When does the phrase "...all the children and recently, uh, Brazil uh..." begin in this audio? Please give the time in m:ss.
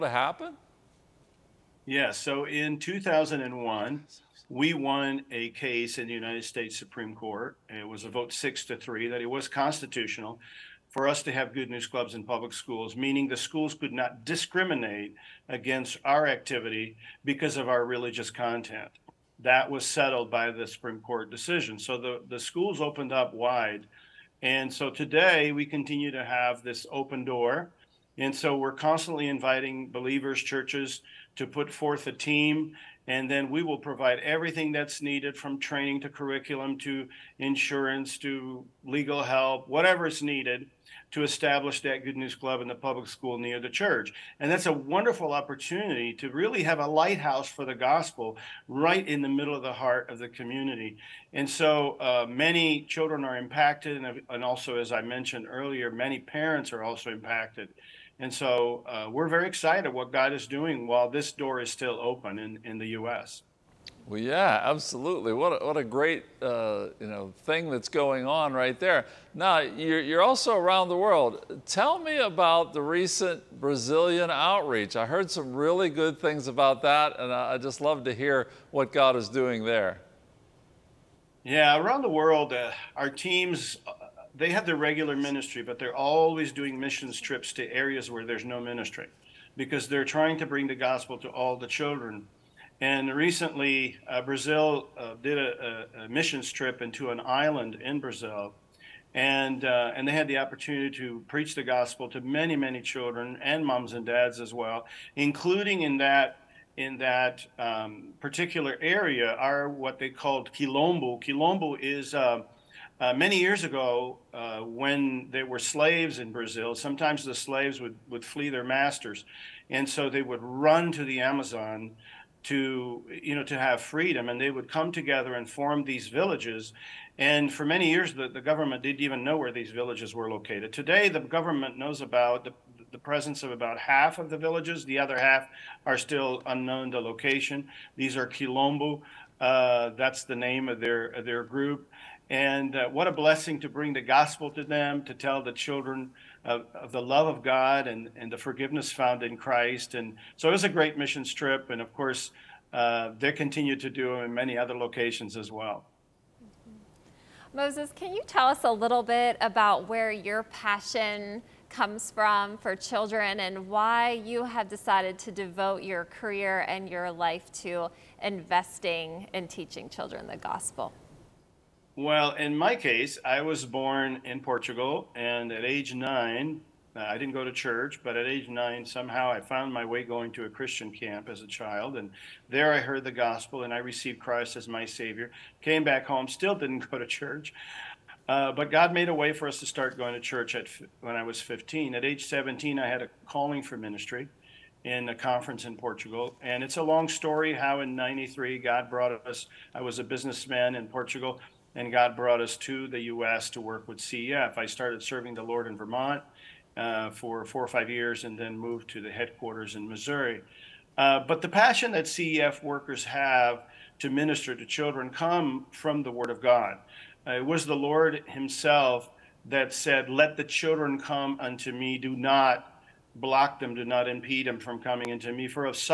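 1:31.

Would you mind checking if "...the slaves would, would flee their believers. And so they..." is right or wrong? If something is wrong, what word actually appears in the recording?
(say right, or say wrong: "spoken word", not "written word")
wrong: "masters", not "believers".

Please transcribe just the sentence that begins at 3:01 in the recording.
And there I heard the gospel and I received Christ as my Savior.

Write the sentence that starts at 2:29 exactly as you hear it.
And so it was a great mission trip.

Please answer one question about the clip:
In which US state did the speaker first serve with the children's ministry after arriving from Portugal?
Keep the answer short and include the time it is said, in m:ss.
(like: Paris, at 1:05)
Vermont, at 3:25.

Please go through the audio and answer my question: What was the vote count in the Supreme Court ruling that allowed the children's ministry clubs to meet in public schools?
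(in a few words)
6 to 3.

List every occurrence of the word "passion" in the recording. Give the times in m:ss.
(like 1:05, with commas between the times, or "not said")
2:40, 3:31.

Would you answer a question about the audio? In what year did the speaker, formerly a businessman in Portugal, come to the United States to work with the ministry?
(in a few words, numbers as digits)
1993.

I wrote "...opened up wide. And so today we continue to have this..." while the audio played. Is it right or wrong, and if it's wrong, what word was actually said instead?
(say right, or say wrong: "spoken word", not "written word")
right.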